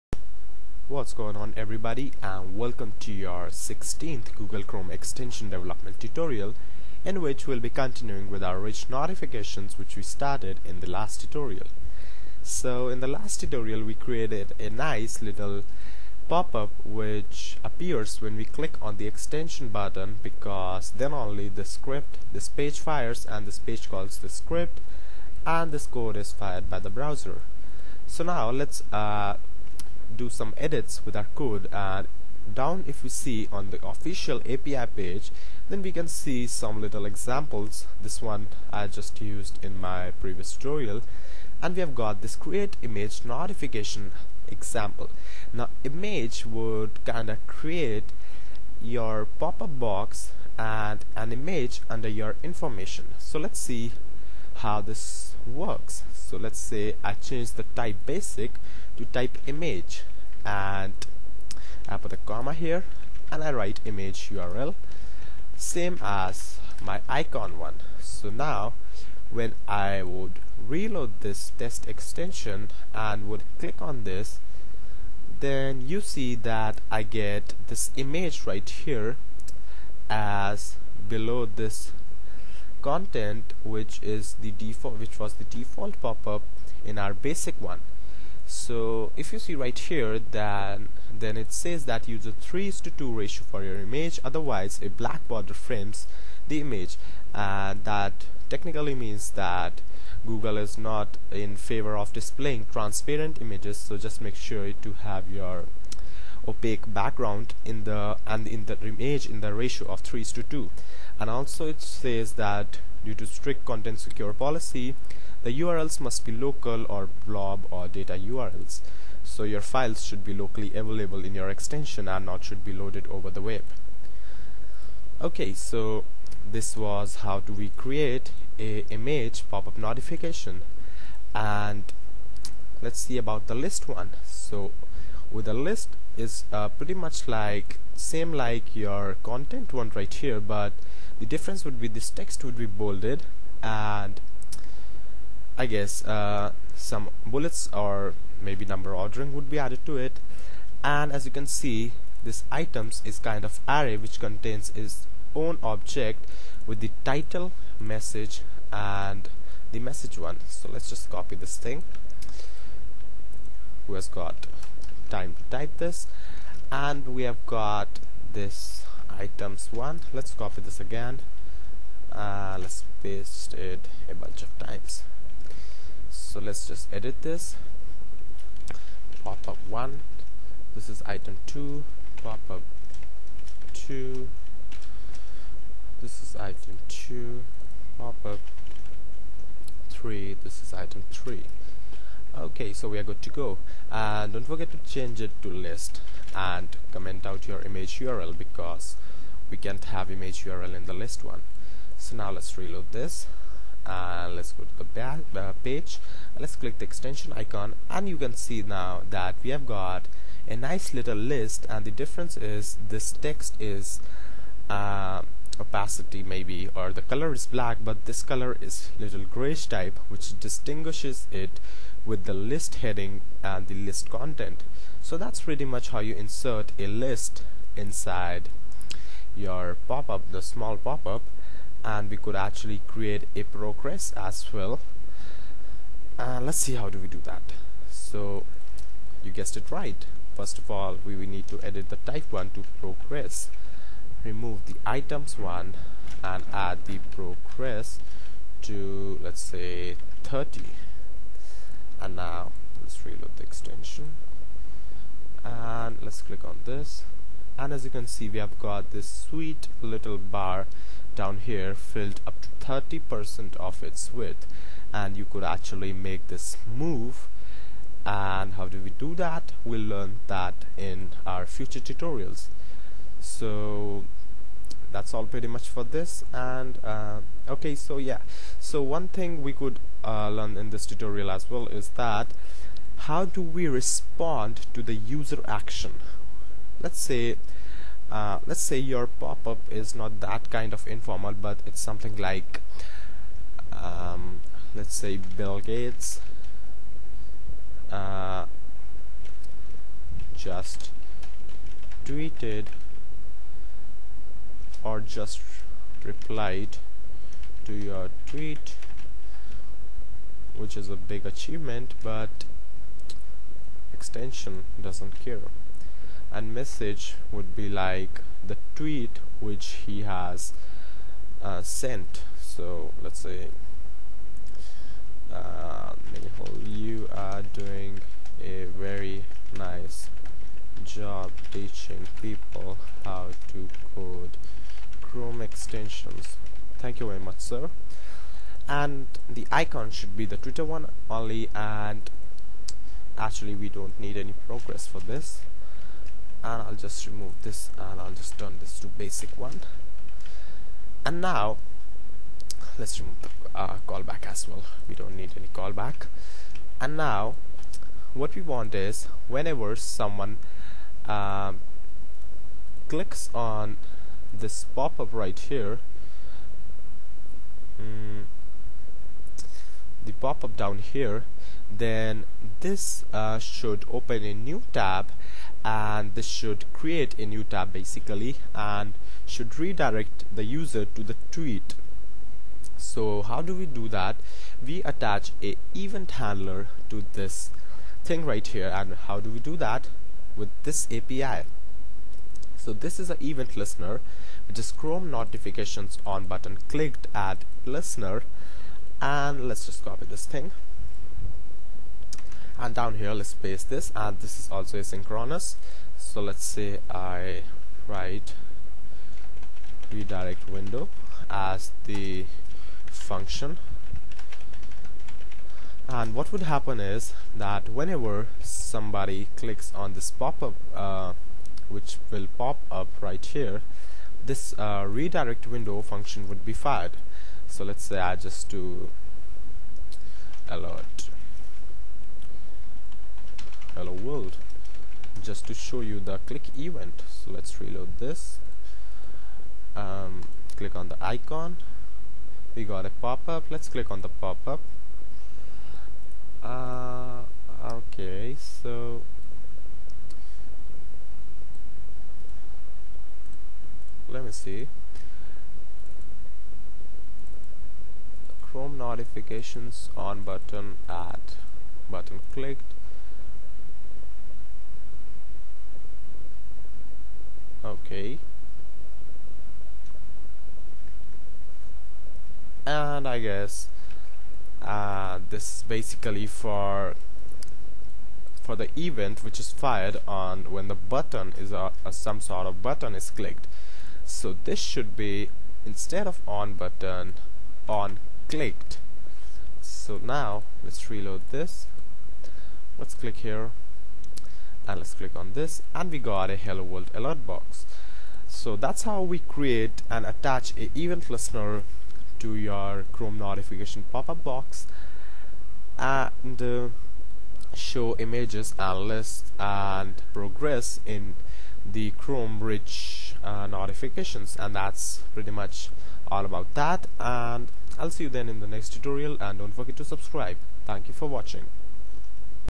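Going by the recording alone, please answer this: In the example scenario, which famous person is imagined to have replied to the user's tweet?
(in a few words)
Bill Gates.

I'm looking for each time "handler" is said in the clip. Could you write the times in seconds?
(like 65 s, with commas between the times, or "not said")
386 s.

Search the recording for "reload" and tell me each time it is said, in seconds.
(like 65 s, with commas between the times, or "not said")
70 s, 202 s, 253 s, 437 s, 490 s.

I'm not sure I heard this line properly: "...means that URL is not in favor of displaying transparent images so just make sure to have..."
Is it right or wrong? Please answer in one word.
wrong.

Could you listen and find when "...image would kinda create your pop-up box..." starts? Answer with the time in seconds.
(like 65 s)
45 s.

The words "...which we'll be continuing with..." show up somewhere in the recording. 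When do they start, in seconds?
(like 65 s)
7 s.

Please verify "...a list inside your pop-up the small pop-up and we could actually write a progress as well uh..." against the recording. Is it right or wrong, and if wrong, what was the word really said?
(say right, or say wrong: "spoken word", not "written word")
wrong: "create", not "write".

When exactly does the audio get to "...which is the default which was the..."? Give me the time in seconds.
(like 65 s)
83 s.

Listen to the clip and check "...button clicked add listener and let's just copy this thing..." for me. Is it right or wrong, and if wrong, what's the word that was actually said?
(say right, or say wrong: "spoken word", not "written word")
right.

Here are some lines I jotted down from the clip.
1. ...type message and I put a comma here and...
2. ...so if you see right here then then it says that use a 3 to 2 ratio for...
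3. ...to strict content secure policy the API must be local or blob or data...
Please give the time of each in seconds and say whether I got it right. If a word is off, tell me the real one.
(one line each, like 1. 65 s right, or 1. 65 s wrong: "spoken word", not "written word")
1. 59 s wrong: "image", not "message"
2. 88 s right
3. 113 s wrong: "URLs", not "API".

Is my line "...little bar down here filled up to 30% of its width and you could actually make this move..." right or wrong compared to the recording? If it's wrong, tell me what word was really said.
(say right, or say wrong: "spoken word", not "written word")
right.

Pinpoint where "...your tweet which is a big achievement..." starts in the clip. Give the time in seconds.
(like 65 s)
307 s.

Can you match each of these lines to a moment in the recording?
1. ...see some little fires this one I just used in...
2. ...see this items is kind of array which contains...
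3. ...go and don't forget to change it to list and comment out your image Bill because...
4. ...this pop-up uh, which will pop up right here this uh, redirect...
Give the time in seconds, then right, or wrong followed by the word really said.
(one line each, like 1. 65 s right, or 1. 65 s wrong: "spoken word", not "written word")
1. 36 s wrong: "examples", not "fires"
2. 151 s right
3. 193 s wrong: "URL", not "Bill"
4. 419 s right.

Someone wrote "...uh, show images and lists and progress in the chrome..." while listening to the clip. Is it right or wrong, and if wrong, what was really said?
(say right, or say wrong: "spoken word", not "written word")
right.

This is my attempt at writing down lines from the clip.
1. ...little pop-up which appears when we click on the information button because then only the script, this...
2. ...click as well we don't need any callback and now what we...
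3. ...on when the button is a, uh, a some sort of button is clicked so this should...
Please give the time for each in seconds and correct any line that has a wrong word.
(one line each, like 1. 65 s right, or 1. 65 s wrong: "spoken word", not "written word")
1. 15 s wrong: "extension", not "information"
2. 353 s wrong: "callback", not "click"
3. 480 s right.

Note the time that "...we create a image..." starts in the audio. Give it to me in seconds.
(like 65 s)
127 s.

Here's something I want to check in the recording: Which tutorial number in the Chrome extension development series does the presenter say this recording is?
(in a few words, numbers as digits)
16th.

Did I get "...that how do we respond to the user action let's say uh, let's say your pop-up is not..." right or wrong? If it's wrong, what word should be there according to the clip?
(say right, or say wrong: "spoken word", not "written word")
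right.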